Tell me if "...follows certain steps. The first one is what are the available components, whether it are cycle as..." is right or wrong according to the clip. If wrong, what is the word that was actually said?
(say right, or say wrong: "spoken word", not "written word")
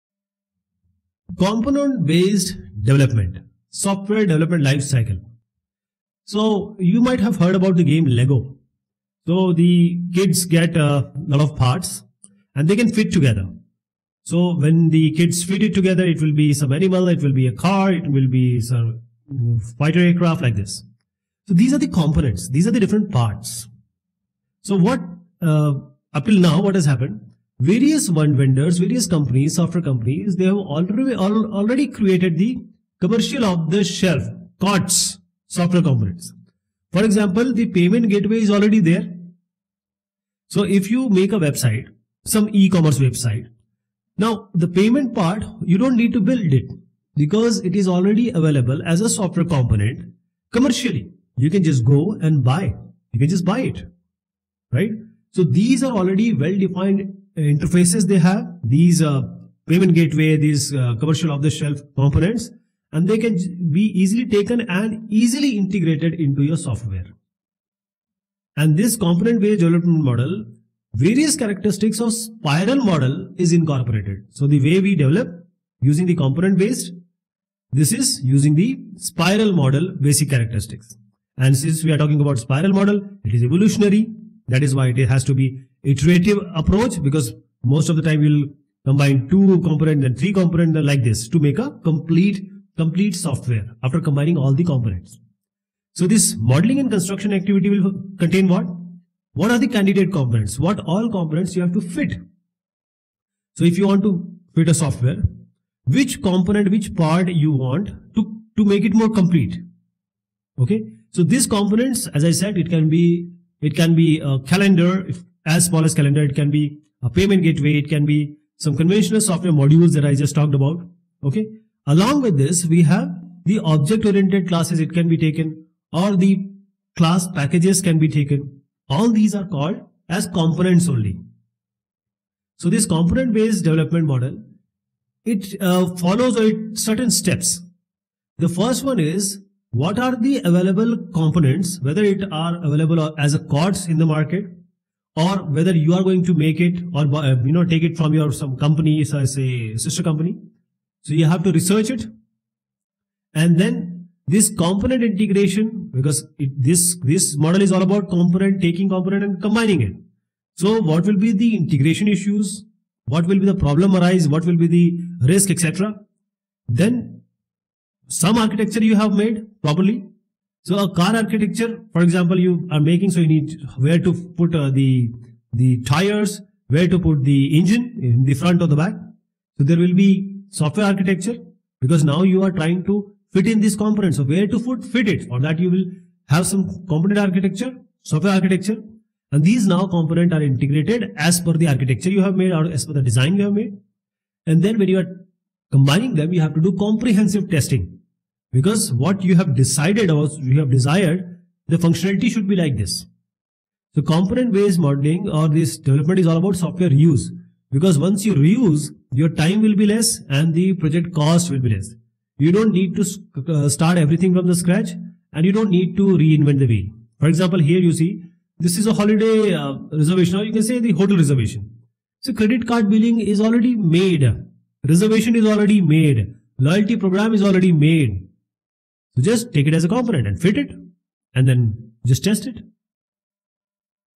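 wrong: "available", not "cycle".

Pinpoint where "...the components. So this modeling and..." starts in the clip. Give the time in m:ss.
1:34.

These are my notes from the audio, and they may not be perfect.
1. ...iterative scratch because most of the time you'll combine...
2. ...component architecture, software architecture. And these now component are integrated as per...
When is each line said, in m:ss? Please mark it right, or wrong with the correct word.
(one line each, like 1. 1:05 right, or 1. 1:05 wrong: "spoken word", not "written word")
1. 1:25 wrong: "approach", not "scratch"
2. 3:06 right.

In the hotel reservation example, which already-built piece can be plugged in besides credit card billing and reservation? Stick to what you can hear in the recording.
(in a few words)
Loyalty program.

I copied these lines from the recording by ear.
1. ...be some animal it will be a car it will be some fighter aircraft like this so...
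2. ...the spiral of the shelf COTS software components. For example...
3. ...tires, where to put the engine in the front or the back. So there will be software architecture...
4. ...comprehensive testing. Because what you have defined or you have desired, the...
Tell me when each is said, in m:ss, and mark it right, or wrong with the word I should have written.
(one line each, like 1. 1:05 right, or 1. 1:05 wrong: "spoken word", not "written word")
1. 0:16 right
2. 0:32 wrong: "commercial", not "spiral"
3. 2:55 right
4. 3:16 wrong: "decided", not "defined".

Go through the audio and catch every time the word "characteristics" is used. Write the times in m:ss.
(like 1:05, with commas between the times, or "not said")
1:11, 1:20.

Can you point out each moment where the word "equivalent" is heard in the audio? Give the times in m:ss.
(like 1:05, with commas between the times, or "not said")
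not said.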